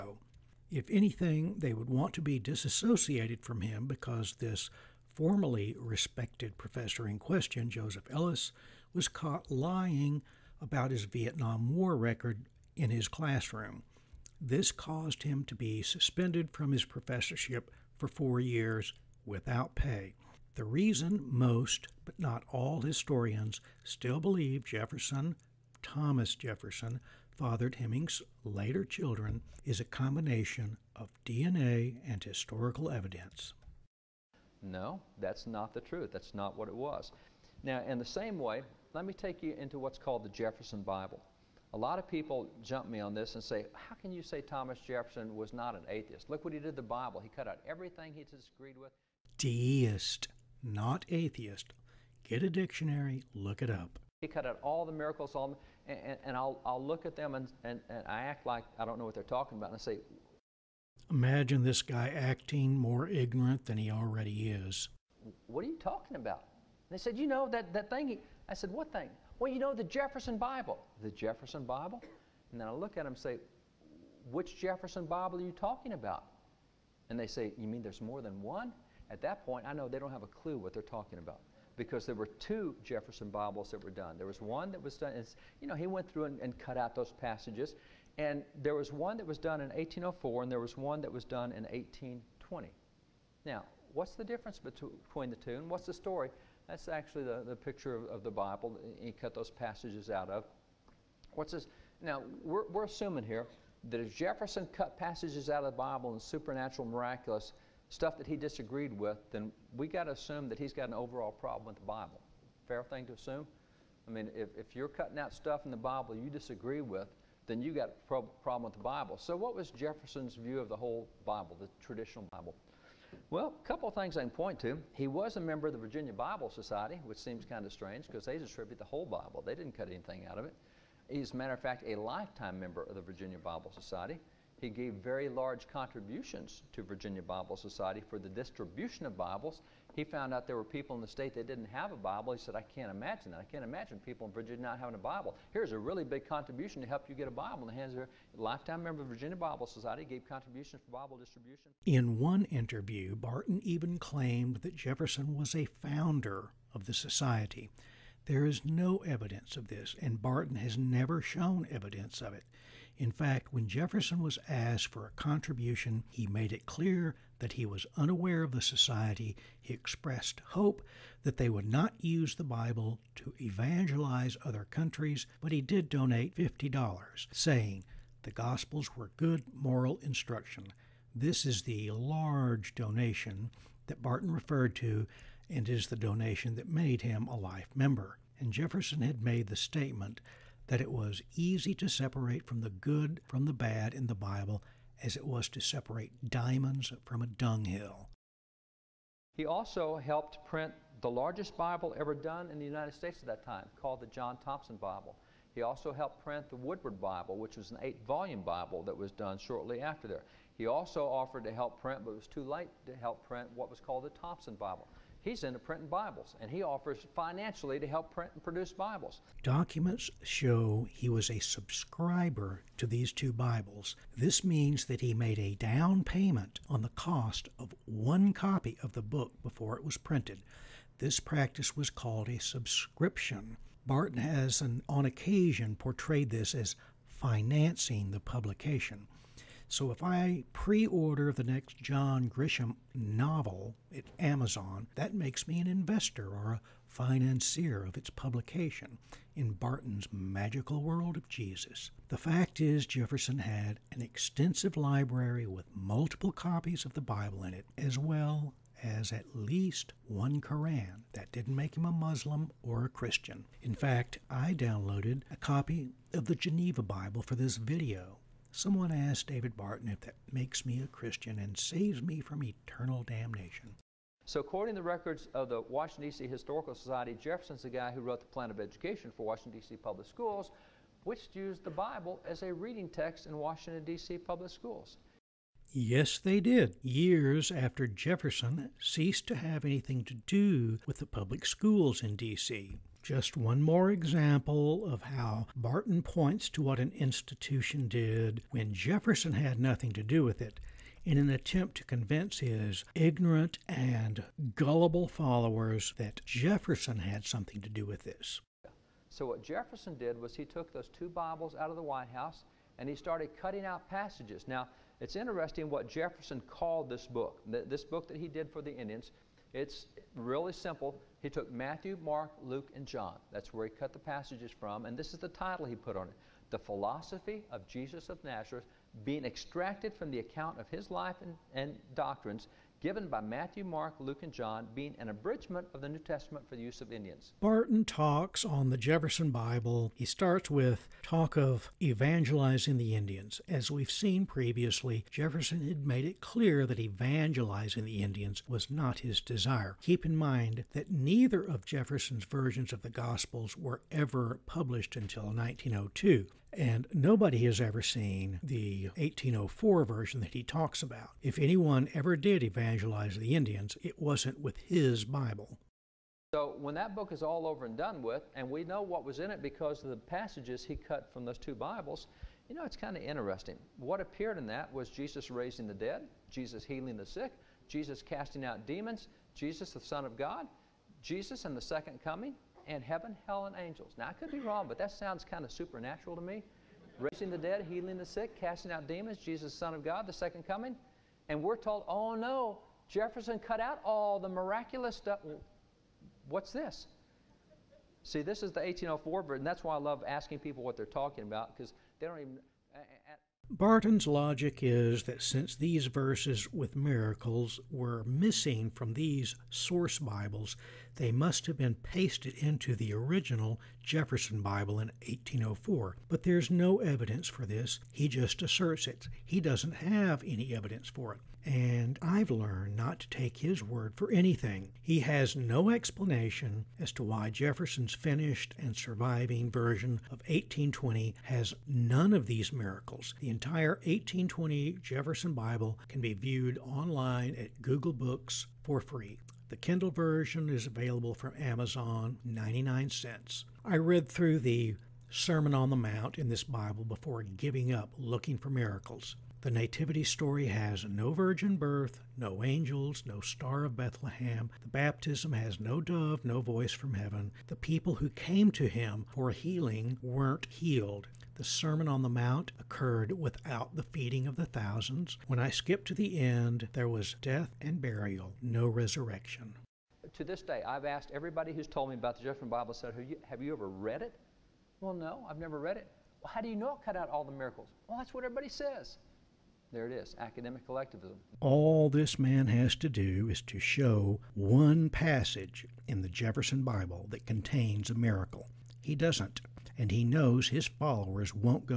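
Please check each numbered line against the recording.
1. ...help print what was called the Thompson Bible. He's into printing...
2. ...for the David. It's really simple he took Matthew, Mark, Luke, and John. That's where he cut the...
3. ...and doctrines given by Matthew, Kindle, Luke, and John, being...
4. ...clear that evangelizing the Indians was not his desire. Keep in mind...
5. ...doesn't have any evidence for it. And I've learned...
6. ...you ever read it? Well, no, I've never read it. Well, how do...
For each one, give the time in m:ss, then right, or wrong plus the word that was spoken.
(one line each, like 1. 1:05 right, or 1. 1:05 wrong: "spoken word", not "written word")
1. 3:32 right
2. 5:18 wrong: "Indians", not "David"
3. 5:31 wrong: "Mark", not "Kindle"
4. 5:46 right
5. 6:59 right
6. 7:53 right.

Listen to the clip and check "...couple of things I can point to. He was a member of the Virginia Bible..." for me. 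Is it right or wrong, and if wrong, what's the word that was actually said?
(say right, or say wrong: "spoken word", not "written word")
right.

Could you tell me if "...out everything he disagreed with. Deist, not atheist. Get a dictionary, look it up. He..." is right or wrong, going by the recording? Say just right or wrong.
right.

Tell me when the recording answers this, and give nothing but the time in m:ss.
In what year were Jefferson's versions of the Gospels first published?
5:55.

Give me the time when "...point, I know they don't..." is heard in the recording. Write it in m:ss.
1:19.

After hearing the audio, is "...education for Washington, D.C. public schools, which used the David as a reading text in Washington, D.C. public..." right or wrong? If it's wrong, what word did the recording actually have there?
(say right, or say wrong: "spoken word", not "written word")
wrong: "Bible", not "David".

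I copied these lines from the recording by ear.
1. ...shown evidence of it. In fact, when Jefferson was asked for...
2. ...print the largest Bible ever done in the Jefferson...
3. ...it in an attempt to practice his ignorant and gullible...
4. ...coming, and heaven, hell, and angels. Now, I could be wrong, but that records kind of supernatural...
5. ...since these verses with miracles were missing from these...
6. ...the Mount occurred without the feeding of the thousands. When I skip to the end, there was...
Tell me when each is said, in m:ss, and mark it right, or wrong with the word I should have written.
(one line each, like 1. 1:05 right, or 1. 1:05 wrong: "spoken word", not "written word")
1. 2:41 right
2. 3:20 wrong: "United", not "Jefferson"
3. 5:00 wrong: "convince", not "practice"
4. 6:22 wrong: "sounds", not "records"
5. 6:45 right
6. 7:42 right.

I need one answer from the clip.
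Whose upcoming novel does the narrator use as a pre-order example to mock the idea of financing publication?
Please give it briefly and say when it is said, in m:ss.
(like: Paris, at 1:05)
John Grisham, at 4:01.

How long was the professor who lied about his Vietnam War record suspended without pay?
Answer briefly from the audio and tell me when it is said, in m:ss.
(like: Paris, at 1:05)
4 years, at 0:18.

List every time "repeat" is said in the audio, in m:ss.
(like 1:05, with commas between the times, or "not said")
not said.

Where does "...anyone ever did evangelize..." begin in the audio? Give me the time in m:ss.
6:01.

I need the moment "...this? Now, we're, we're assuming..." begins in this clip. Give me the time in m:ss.
1:41.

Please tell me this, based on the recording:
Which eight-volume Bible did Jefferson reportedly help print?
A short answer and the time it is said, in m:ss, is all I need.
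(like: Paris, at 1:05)
Woodward Bible, at 3:26.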